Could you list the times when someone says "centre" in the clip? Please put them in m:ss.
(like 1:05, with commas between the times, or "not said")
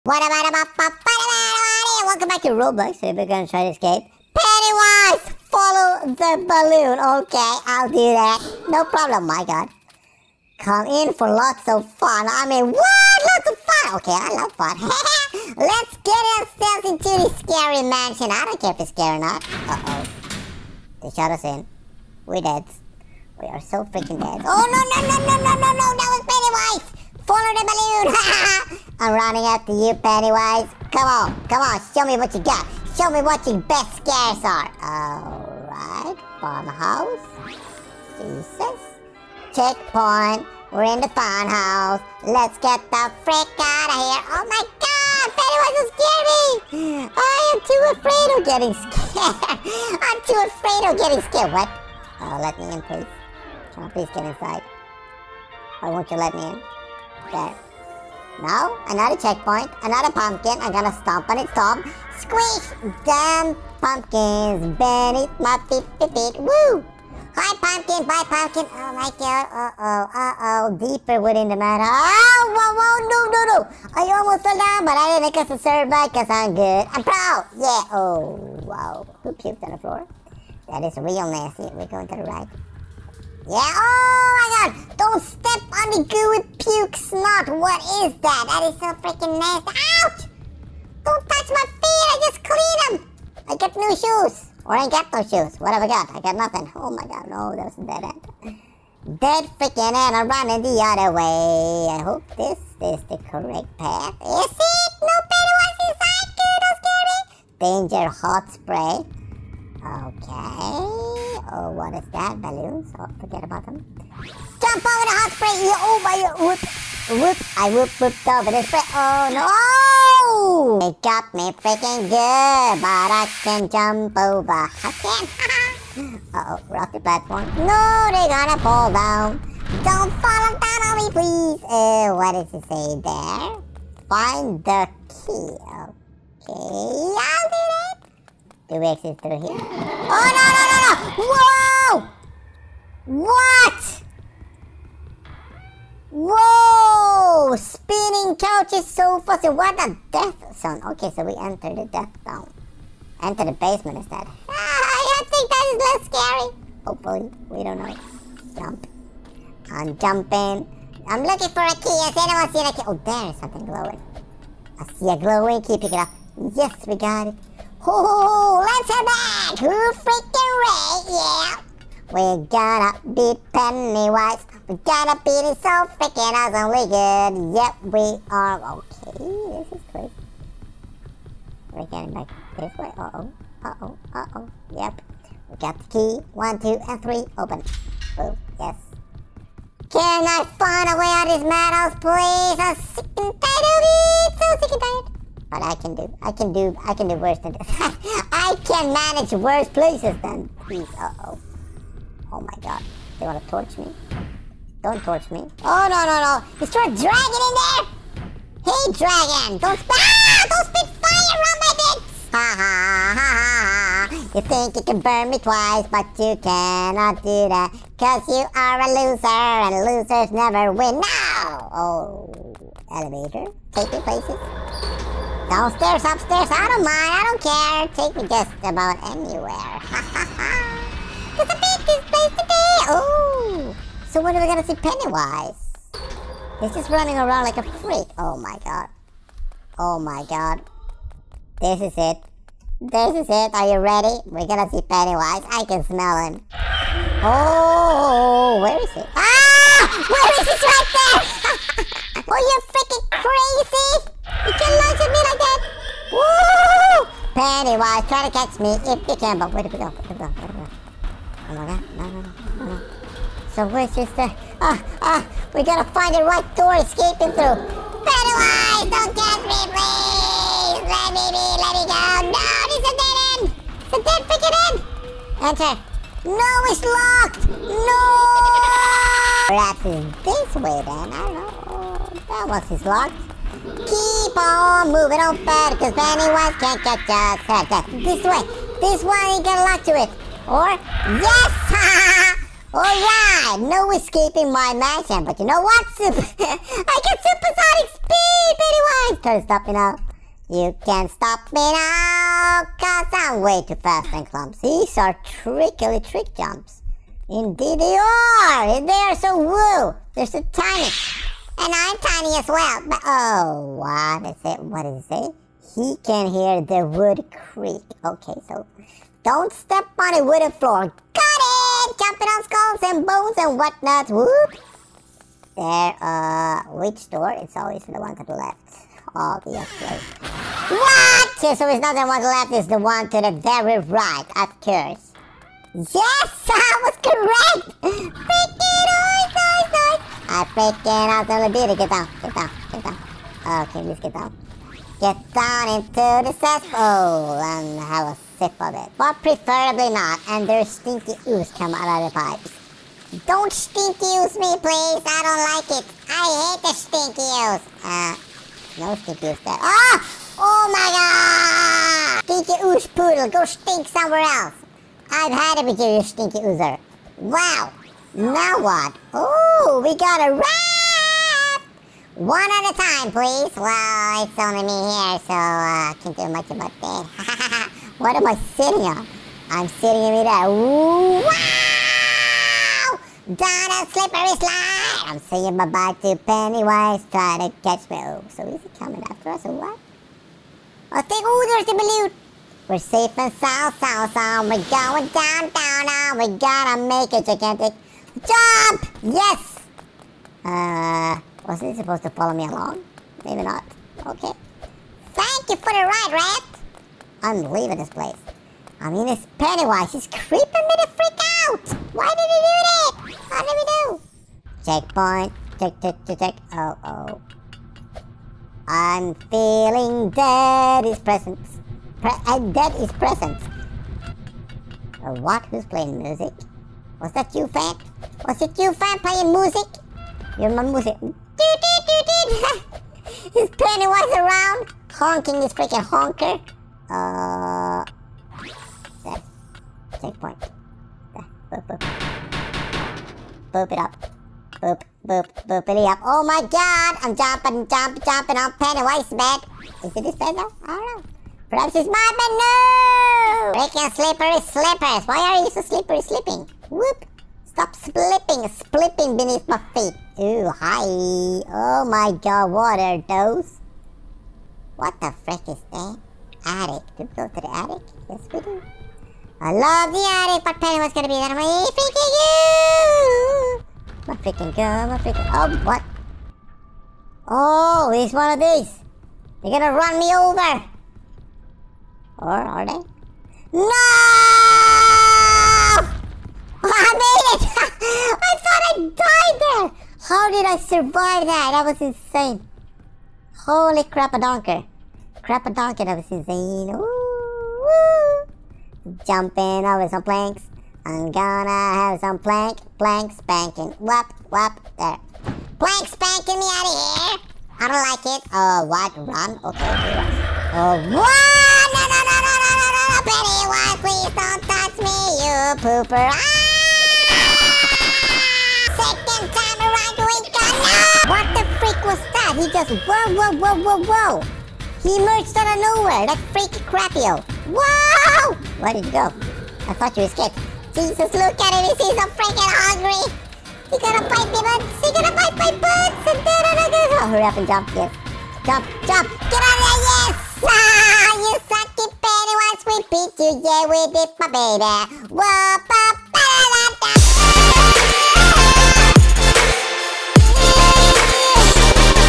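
not said.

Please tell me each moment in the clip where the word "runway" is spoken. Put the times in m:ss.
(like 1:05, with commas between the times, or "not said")
not said.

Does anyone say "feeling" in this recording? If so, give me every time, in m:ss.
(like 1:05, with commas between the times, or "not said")
6:59.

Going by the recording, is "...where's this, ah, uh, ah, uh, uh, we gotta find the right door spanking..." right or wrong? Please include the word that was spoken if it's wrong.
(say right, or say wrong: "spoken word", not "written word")
wrong: "escaping", not "spanking".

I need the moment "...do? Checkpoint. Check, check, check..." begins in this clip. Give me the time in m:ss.
6:53.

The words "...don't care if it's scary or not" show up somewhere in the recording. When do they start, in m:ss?
0:18.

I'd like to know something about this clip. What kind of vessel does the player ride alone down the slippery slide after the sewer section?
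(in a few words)
a raft.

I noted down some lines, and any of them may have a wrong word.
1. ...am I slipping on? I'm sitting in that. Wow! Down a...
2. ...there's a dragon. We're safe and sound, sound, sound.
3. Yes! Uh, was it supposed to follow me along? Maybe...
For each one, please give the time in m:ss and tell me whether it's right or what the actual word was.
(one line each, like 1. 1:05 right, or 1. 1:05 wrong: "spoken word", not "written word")
1. 6:18 wrong: "sitting", not "slipping"
2. 6:31 wrong: "balloon", not "dragon"
3. 6:39 right.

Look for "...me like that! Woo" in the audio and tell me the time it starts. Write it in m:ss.
4:15.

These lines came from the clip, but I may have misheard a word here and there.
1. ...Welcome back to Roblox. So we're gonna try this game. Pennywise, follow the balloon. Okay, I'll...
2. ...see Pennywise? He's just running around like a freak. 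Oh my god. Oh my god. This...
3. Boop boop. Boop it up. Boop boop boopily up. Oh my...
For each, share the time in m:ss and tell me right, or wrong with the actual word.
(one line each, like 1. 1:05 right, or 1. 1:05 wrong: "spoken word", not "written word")
1. 0:02 right
2. 3:54 right
3. 7:21 right.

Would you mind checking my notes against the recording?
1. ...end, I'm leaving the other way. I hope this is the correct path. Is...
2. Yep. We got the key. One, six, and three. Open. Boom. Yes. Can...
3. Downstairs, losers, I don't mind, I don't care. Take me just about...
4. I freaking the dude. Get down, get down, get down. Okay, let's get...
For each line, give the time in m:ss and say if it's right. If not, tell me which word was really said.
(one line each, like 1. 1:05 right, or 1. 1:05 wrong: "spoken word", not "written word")
1. 1:39 wrong: "running", not "leaving"
2. 3:04 wrong: "two", not "six"
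3. 3:45 wrong: "upstairs", not "losers"
4. 5:40 right.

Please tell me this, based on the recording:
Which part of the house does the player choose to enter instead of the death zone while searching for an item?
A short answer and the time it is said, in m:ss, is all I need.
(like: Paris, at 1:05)
the basement, at 2:33.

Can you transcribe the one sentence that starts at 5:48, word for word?
But preferably not, and there's stinky ooze come out of the pipes.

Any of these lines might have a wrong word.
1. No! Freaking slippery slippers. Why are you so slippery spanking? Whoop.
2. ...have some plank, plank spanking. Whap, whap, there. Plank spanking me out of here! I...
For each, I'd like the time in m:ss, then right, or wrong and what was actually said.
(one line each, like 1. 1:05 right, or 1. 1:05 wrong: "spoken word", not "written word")
1. 7:32 wrong: "slipping", not "spanking"
2. 8:21 right.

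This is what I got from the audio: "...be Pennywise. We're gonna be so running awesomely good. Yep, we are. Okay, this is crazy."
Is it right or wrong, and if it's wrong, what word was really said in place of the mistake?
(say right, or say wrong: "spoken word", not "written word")
wrong: "freaking", not "running".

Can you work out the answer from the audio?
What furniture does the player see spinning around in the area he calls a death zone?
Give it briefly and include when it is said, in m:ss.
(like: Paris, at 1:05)
couches, at 2:27.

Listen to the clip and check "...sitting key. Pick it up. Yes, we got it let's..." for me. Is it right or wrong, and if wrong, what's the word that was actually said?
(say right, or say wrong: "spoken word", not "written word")
wrong: "glowing", not "sitting".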